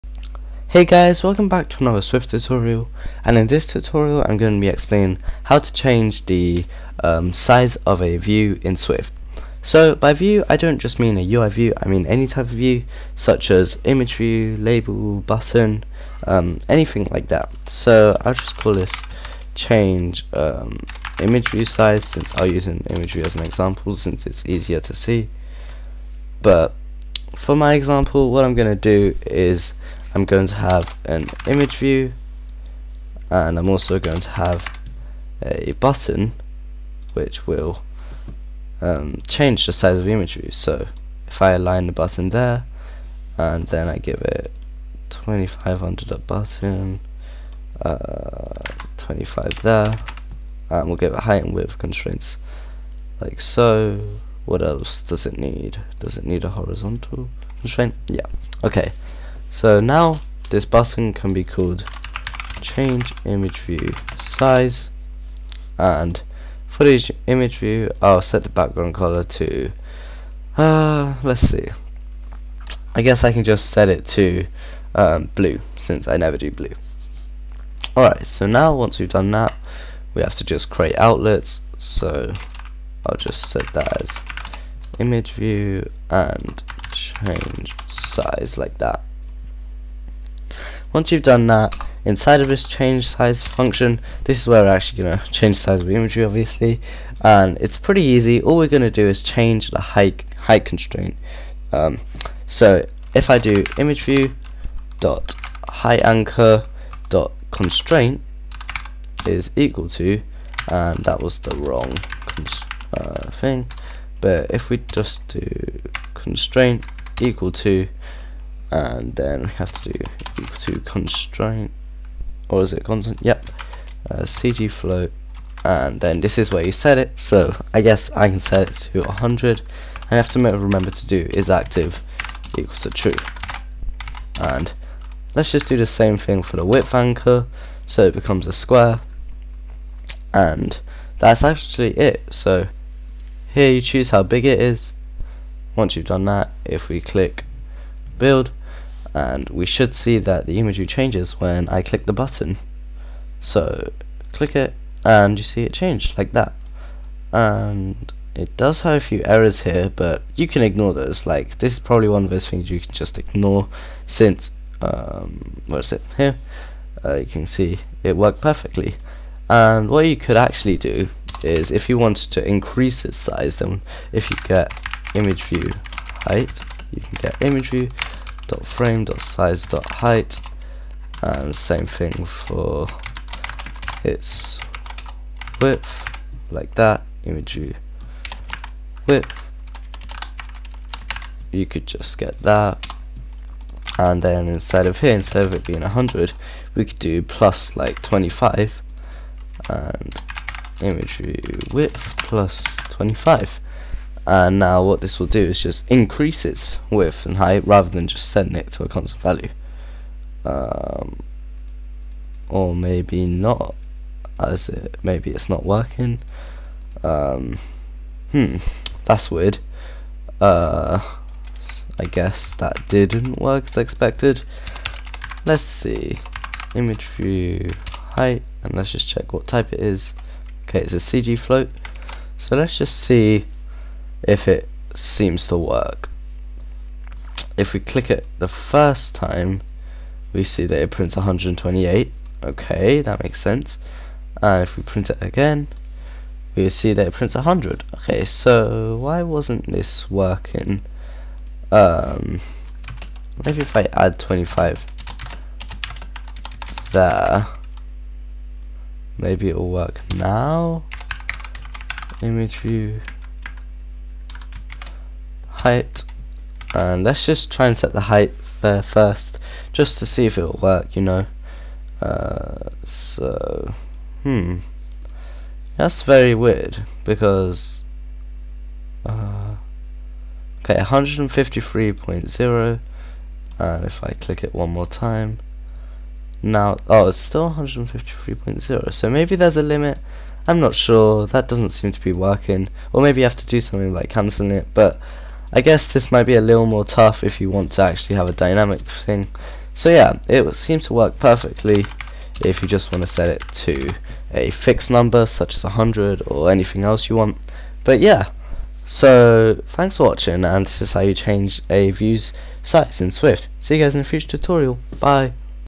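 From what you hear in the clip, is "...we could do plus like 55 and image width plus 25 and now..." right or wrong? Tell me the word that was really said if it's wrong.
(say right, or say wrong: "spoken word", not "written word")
wrong: "25", not "55".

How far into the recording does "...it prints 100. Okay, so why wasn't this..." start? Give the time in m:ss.
4:07.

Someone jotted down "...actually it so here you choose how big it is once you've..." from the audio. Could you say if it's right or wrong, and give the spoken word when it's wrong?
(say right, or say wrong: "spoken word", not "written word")
right.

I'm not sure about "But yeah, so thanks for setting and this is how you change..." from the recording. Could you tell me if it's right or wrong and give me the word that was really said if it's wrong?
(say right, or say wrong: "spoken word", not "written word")
wrong: "watching", not "setting".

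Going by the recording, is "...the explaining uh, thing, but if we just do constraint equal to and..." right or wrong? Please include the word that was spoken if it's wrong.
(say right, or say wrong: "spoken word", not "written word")
wrong: "wrong", not "explaining".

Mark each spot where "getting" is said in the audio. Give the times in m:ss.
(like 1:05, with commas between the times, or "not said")
not said.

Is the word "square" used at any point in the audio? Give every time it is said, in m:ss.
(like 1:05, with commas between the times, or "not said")
2:18.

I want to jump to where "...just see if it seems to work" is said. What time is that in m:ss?
3:52.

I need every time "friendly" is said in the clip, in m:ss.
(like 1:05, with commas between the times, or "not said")
not said.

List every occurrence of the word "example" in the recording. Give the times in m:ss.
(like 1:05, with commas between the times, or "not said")
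0:23, 0:27.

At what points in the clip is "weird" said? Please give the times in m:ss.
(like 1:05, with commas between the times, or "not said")
3:39, 4:36.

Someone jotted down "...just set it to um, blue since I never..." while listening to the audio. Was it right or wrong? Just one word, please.
right.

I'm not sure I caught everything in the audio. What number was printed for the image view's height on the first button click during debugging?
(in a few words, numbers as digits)
128.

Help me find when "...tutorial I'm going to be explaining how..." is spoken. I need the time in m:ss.
0:03.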